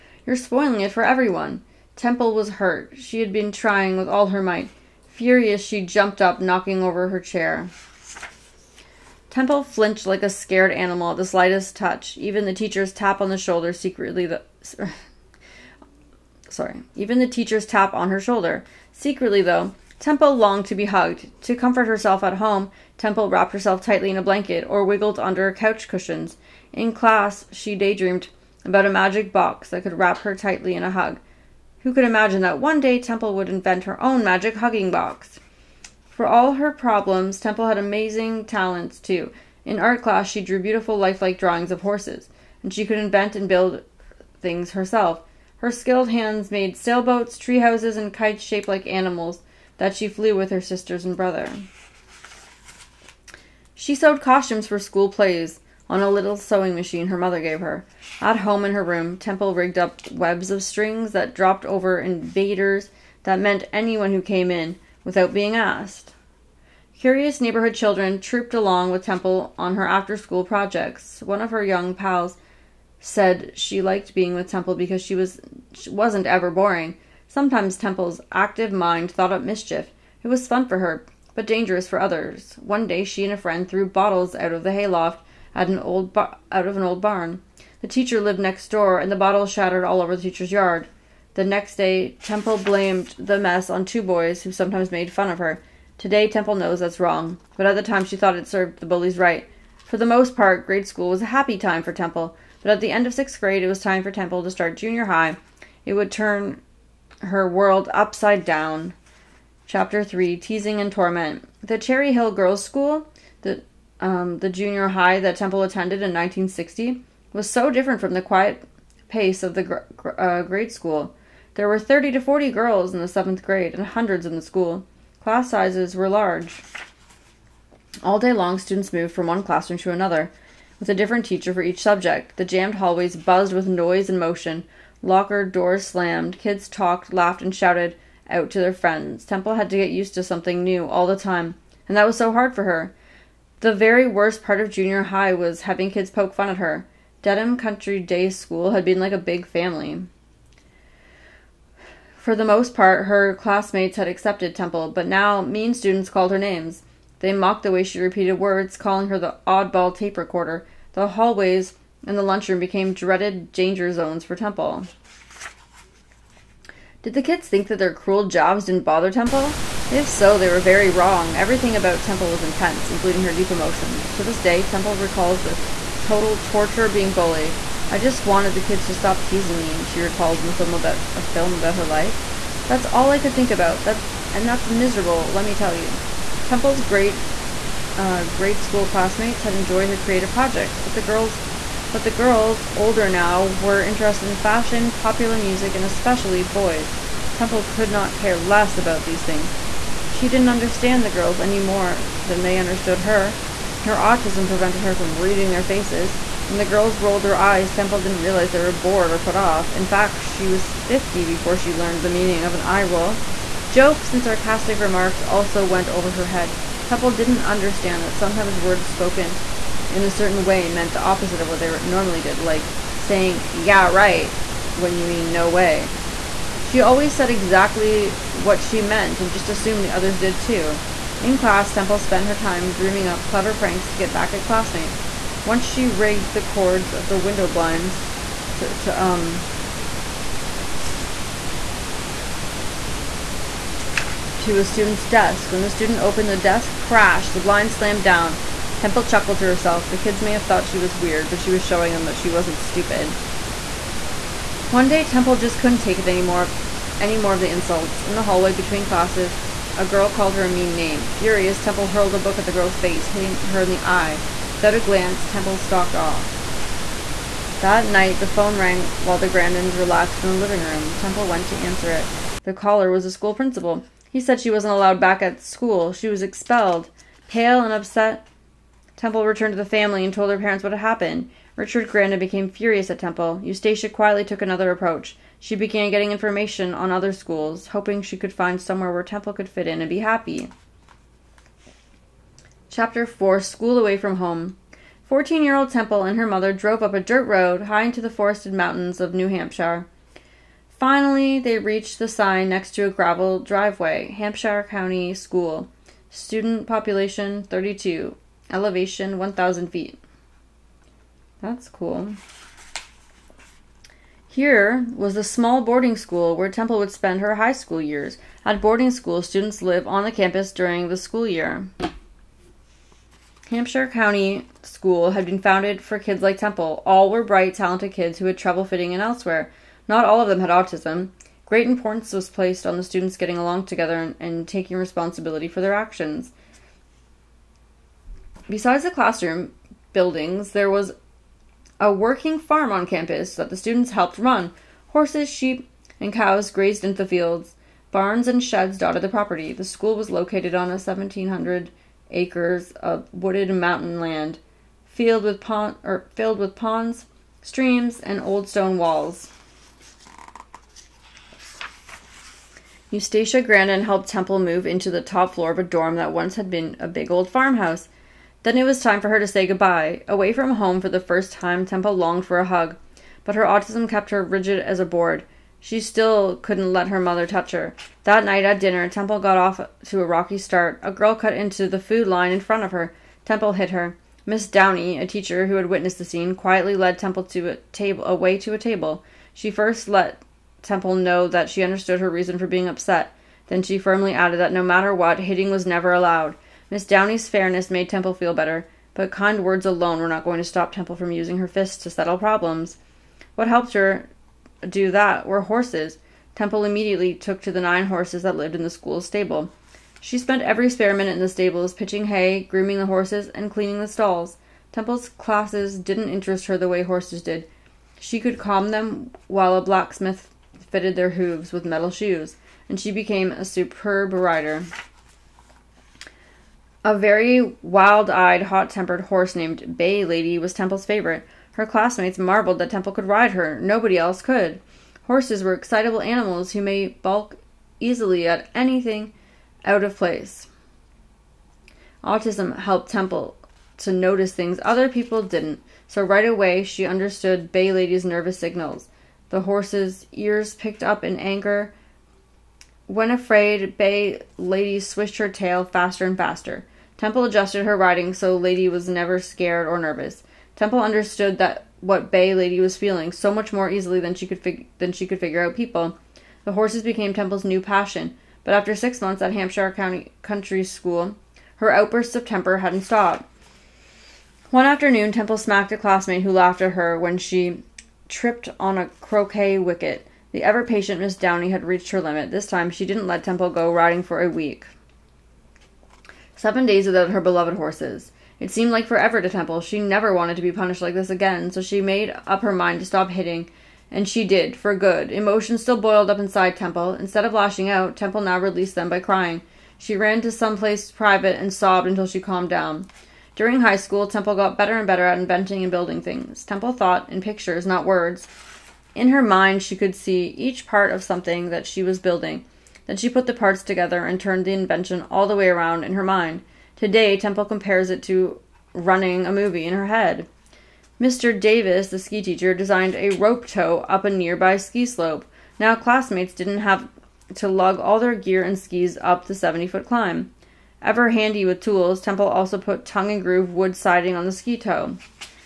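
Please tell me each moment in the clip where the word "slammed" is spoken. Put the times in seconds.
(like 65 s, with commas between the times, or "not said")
135 s, 247 s.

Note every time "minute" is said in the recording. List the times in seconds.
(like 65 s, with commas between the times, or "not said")
410 s.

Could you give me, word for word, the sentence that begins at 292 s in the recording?
Chapter 4 School Away from Home.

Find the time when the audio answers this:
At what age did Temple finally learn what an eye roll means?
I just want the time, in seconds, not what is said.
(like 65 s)
210 s.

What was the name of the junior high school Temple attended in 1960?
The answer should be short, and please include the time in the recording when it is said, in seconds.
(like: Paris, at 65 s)
Cherry Hill Girls' School, at 111 s.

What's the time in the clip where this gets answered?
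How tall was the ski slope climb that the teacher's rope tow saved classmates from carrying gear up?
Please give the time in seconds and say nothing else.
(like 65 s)
529 s.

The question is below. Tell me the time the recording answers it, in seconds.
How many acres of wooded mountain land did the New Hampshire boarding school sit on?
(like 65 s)
350 s.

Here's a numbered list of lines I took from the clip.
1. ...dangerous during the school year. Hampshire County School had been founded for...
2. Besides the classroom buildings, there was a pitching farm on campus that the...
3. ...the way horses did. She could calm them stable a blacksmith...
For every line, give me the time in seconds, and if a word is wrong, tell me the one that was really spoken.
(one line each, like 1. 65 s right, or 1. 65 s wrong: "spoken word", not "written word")
1. 320 s wrong: "campus", not "dangerous"
2. 338 s wrong: "working", not "pitching"
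3. 416 s wrong: "while", not "stable".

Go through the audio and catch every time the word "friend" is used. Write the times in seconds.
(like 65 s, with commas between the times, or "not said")
83 s, 138 s.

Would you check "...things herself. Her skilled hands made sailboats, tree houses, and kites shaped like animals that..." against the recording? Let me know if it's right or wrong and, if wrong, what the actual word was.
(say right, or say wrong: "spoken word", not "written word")
right.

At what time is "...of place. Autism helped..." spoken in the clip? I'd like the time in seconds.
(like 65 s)
439 s.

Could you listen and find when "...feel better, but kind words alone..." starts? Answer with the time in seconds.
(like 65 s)
398 s.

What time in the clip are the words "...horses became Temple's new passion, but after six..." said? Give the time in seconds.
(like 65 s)
466 s.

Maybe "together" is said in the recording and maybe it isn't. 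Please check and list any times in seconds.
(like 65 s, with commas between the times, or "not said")
333 s, 513 s.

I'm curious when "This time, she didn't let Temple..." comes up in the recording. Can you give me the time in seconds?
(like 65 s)
482 s.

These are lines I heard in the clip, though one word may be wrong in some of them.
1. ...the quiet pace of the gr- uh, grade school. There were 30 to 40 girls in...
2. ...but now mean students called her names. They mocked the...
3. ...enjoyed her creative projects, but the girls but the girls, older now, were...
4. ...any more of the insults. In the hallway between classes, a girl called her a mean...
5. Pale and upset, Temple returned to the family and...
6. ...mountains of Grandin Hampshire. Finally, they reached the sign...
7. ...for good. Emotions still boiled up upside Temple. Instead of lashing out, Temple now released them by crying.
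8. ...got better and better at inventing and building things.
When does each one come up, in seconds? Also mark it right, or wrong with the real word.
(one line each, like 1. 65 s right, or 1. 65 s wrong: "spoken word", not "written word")
1. 118 s right
2. 154 s right
3. 189 s right
4. 256 s right
5. 277 s right
6. 298 s wrong: "New", not "Grandin"
7. 494 s wrong: "inside", not "upside"
8. 504 s right.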